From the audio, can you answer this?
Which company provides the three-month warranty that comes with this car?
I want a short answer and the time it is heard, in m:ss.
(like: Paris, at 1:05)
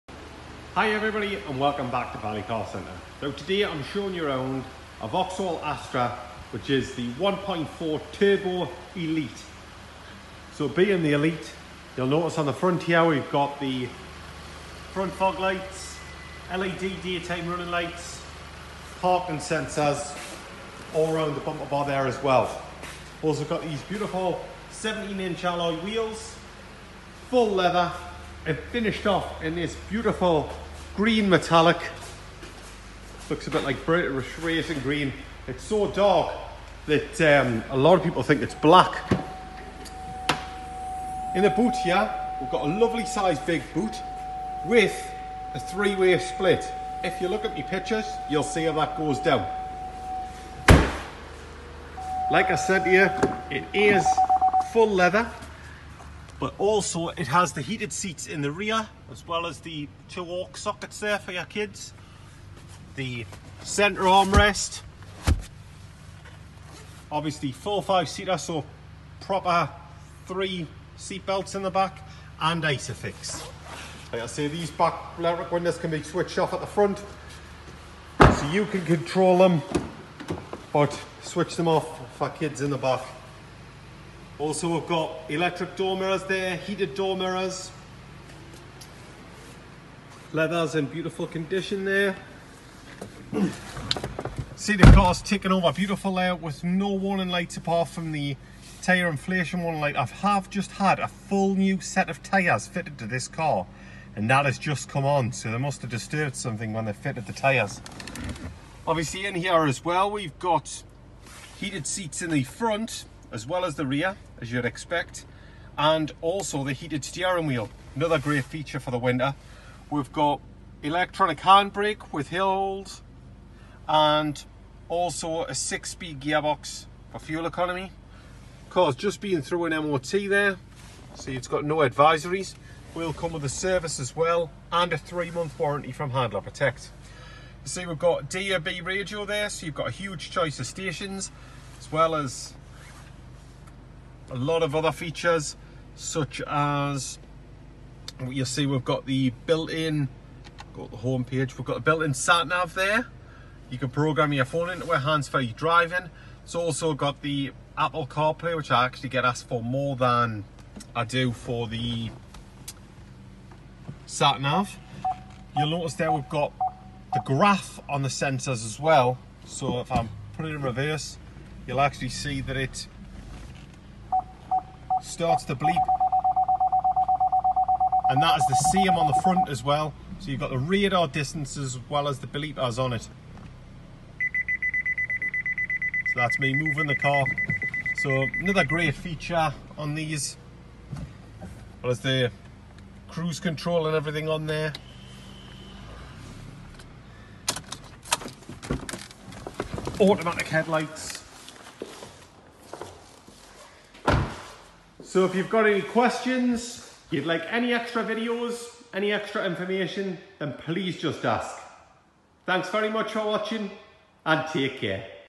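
Handler Protect, at 2:16.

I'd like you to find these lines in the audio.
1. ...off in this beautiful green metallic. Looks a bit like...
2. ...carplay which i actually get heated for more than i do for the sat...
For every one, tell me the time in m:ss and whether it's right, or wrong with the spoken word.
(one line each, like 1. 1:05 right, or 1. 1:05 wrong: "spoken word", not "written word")
1. 0:29 right
2. 2:38 wrong: "asked", not "heated".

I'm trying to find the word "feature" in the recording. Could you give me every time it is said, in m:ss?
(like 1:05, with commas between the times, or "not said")
1:58, 2:24, 3:08.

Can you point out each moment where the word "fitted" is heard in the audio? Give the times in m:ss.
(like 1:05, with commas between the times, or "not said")
1:42, 1:46.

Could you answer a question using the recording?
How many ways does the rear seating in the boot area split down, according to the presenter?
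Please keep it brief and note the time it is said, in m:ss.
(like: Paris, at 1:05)
three-way, at 0:45.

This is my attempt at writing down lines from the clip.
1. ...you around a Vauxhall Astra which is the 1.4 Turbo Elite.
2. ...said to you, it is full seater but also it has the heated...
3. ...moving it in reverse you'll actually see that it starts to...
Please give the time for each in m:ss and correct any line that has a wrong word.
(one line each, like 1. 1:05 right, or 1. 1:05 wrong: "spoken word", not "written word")
1. 0:04 right
2. 0:52 wrong: "leather", not "seater"
3. 2:50 wrong: "putting", not "moving".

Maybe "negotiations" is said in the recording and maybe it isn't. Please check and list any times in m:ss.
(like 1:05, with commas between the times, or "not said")
not said.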